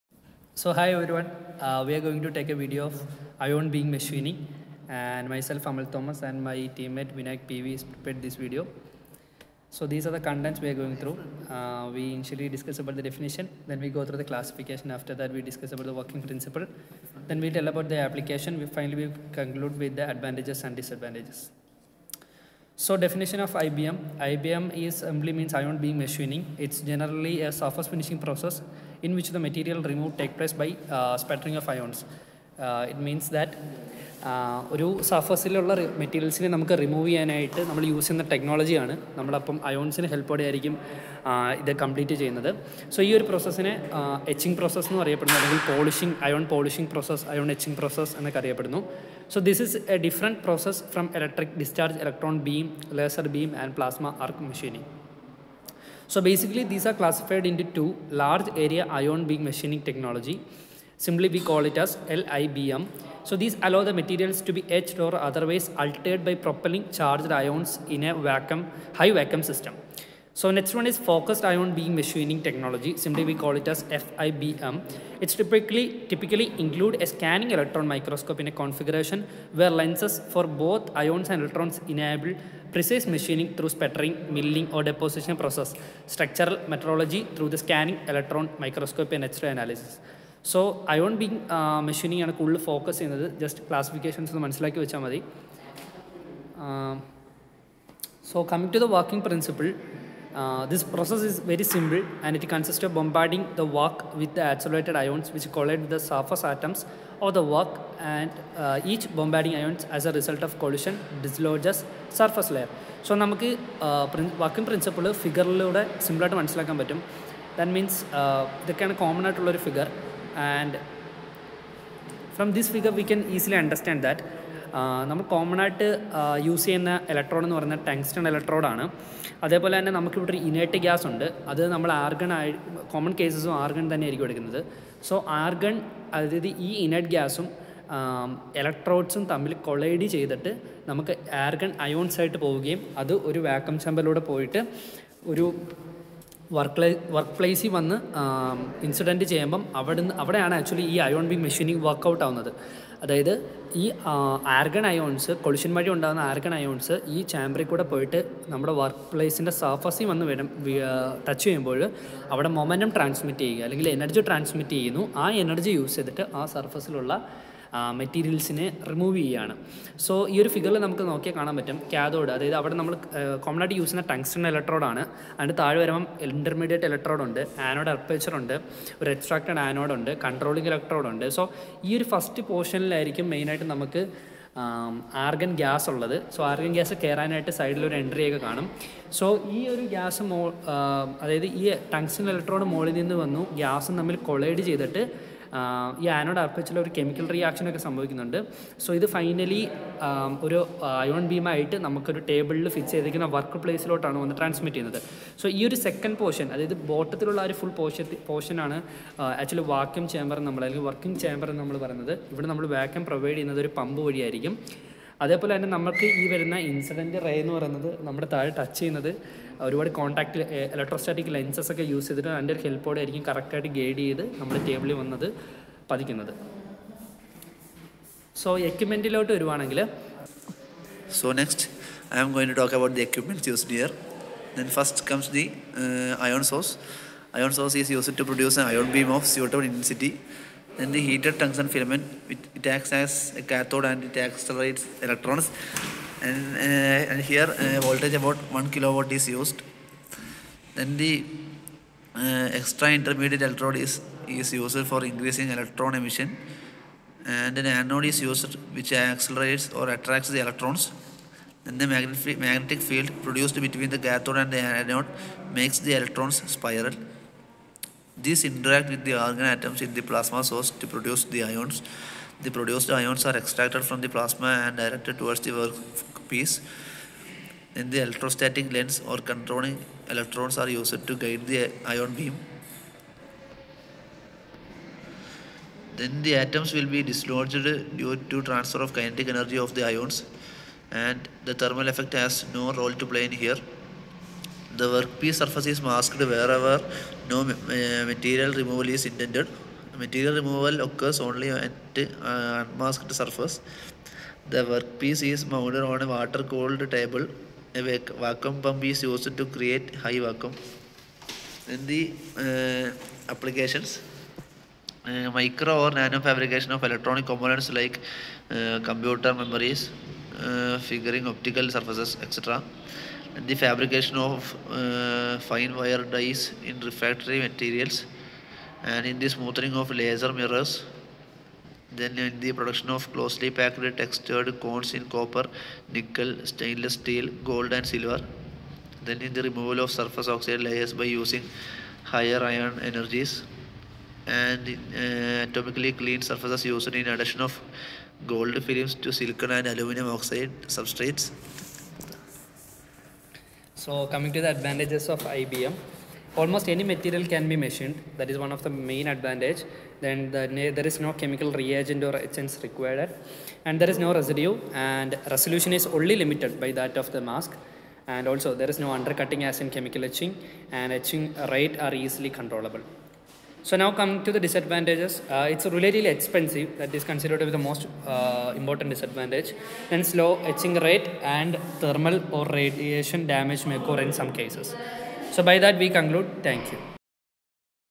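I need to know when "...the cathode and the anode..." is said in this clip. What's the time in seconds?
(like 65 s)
263 s.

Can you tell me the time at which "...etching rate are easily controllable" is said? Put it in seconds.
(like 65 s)
370 s.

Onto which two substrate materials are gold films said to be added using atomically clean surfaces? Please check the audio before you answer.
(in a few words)
silicon and aluminum oxide.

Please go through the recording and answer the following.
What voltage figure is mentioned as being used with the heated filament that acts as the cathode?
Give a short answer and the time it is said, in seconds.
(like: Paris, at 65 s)
1 kilowatt, at 248 s.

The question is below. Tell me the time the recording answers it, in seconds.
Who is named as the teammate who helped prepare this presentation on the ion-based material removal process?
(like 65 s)
7 s.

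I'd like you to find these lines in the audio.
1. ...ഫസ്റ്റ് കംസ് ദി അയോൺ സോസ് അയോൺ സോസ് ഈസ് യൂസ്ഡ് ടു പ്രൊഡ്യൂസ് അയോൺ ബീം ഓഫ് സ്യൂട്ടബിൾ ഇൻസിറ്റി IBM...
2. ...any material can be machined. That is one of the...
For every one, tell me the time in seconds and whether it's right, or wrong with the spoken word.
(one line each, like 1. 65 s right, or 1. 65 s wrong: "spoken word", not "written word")
1. 234 s wrong: "Then", not "IBM"
2. 356 s right.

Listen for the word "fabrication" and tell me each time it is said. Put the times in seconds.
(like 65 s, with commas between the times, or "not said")
316 s, 323 s.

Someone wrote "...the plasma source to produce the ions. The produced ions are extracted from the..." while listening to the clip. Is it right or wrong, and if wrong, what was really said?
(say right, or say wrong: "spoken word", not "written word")
right.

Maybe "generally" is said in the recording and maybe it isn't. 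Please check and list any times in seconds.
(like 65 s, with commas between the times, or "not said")
26 s.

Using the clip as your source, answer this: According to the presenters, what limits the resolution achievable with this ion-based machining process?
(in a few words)
the mask.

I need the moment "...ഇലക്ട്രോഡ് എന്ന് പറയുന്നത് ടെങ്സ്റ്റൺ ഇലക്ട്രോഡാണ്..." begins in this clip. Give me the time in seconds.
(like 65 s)
127 s.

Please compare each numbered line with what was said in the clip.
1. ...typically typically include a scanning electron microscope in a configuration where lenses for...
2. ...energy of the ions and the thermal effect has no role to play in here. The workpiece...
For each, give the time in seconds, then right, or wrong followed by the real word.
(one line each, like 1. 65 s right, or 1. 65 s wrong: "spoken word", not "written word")
1. 75 s right
2. 289 s right.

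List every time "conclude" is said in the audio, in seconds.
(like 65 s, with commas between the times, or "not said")
19 s, 385 s.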